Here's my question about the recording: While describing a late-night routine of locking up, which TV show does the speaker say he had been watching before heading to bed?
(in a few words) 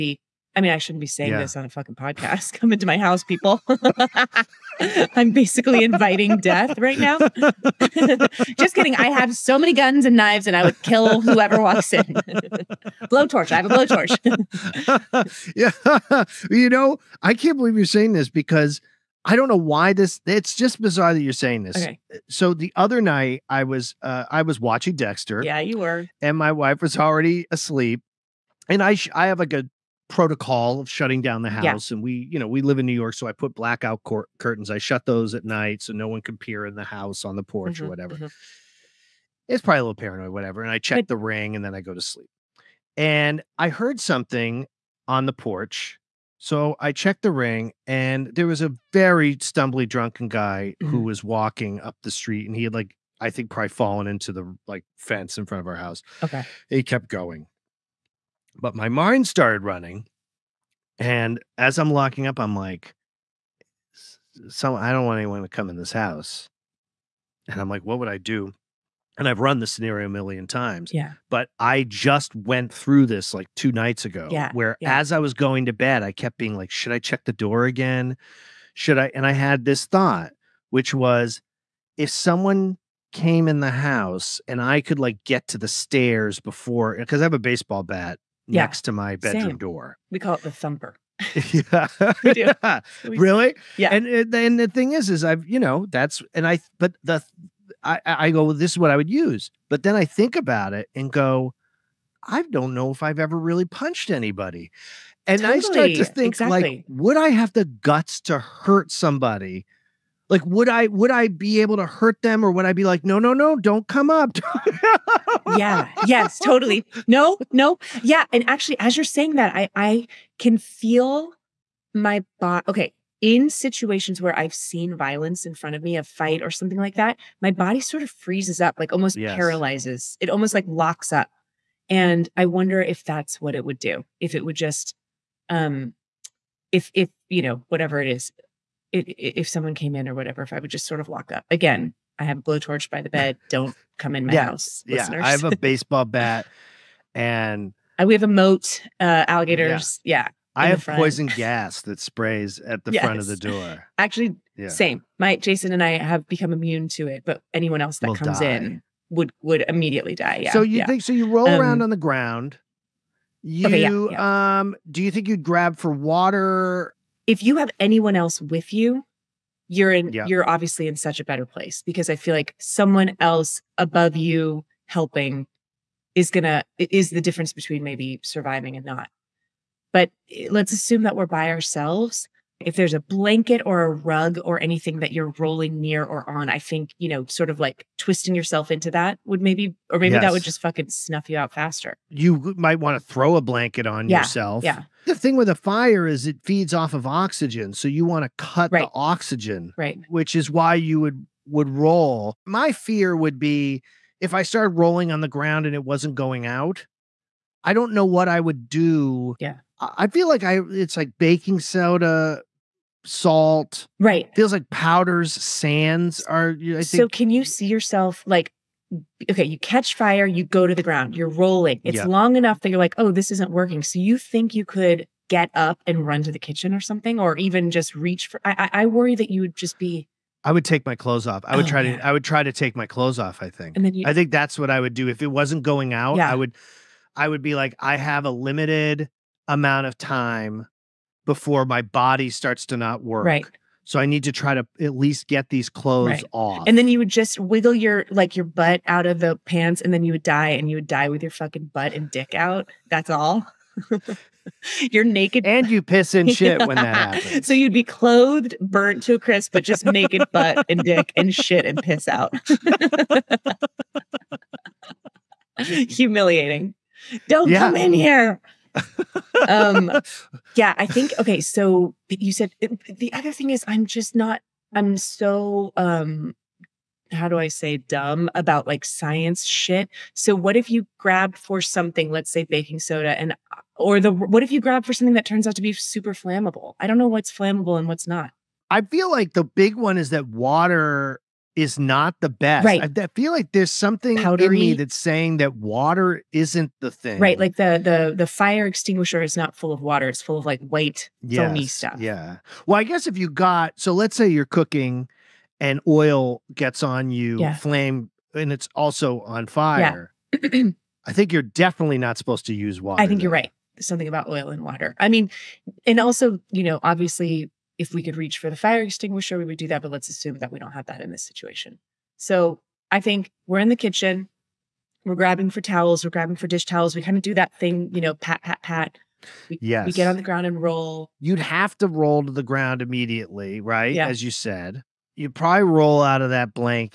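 Dexter.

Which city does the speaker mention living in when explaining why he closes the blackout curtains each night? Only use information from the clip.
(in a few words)
New York.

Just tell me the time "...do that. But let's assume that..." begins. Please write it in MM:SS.
05:19.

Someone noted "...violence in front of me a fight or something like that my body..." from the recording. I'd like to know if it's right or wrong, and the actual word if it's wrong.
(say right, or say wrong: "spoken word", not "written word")
right.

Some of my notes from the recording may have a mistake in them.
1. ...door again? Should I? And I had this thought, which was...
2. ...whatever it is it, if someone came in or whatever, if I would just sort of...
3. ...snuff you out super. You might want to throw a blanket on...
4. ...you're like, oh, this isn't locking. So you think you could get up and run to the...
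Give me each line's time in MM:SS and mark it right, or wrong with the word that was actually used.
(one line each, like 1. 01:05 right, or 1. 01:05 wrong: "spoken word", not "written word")
1. 01:17 right
2. 02:17 right
3. 03:10 wrong: "faster", not "super"
4. 03:42 wrong: "working", not "locking".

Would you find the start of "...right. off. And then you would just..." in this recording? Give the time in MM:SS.
04:06.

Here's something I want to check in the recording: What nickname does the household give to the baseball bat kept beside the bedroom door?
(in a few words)
the thumper.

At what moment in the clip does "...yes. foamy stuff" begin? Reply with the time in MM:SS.
05:01.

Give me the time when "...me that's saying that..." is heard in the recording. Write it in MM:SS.
04:54.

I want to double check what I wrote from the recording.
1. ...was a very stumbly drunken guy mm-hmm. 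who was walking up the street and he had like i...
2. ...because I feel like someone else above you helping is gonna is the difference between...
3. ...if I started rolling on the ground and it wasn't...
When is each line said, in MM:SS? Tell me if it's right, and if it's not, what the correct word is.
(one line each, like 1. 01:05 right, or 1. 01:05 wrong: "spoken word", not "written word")
1. 00:48 right
2. 02:51 right
3. 03:24 right.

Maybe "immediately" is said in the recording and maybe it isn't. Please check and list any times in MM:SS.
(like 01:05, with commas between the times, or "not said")
02:39, 05:32.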